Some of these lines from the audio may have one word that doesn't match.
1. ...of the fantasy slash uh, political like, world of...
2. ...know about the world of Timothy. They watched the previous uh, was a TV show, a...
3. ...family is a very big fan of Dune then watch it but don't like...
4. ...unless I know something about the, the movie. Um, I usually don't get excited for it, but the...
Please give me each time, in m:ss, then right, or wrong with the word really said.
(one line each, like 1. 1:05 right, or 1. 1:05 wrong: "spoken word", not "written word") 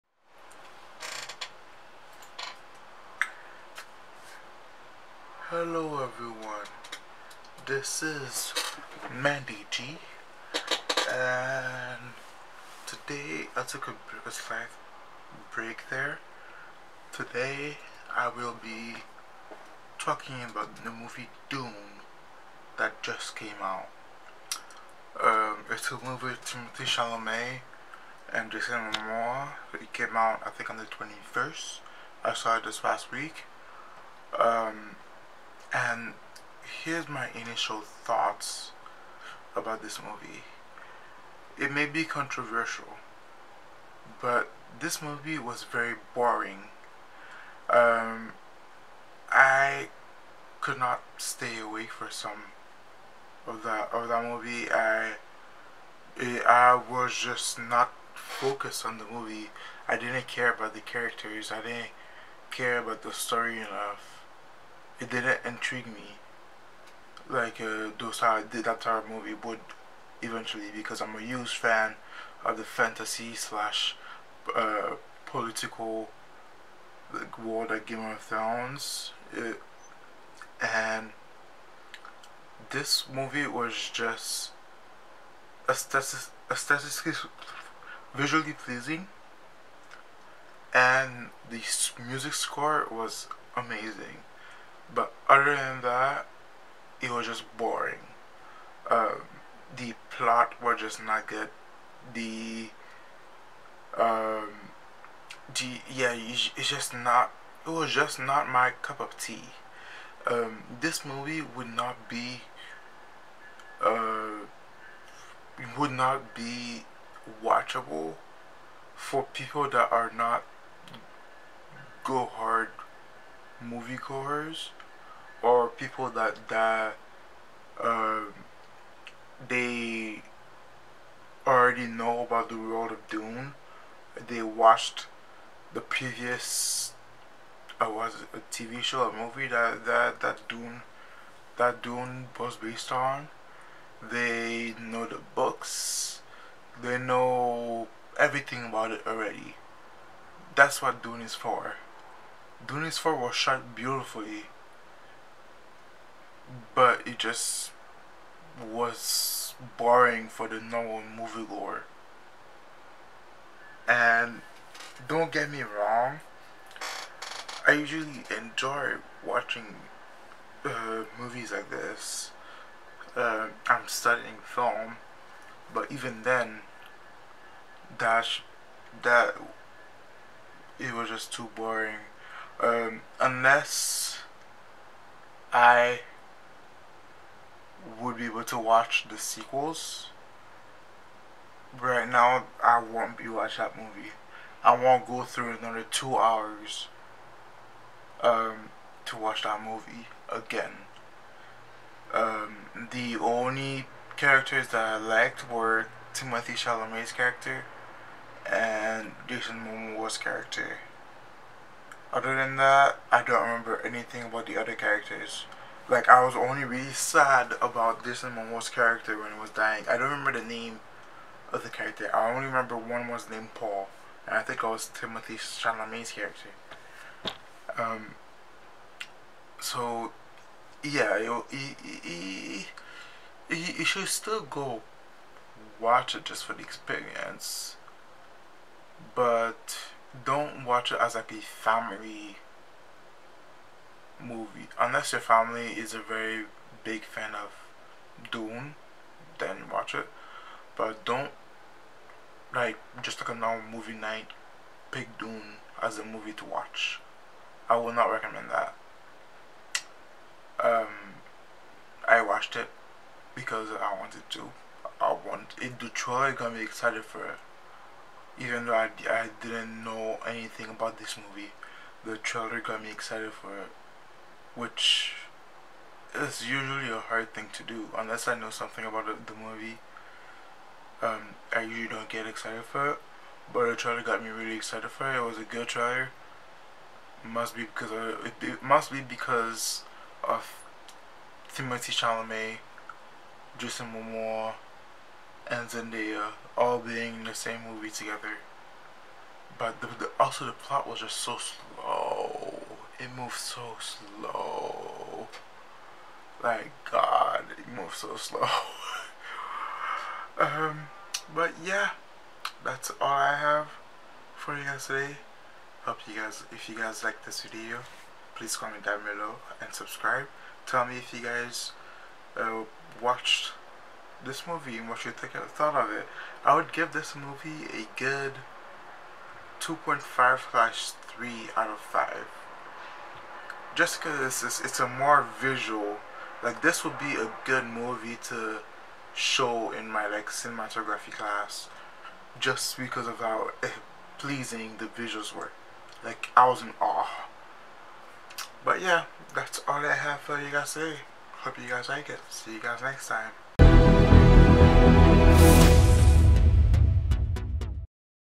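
1. 1:12 right
2. 2:11 wrong: "Dune", not "Timothy"
3. 4:05 right
4. 4:37 right.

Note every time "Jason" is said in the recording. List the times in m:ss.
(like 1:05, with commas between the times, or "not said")
0:28, 3:29, 3:38, 4:53.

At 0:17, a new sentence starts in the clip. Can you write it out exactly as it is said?
Today I will be talking about the movie Dune that just came out.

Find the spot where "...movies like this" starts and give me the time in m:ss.
2:51.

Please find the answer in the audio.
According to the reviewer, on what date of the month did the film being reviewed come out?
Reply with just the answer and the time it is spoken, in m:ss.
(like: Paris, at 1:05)
21st, at 0:30.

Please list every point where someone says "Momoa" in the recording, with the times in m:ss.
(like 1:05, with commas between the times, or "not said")
0:28, 3:29, 3:38, 4:53.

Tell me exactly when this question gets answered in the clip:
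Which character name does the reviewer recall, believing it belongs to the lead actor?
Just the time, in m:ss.
3:43.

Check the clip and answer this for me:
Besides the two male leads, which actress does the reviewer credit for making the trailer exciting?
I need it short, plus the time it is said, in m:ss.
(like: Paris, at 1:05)
Zendaya, at 4:55.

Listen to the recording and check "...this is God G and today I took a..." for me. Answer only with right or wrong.
wrong.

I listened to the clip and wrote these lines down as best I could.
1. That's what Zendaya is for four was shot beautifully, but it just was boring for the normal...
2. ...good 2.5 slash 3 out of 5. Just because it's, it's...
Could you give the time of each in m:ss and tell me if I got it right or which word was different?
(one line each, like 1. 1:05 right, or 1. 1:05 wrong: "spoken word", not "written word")
1. 2:30 wrong: "Dune", not "Zendaya"
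2. 5:27 right.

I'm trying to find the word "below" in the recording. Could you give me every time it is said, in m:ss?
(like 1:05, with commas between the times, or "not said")
5:19.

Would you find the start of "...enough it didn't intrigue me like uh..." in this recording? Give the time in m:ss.
1:03.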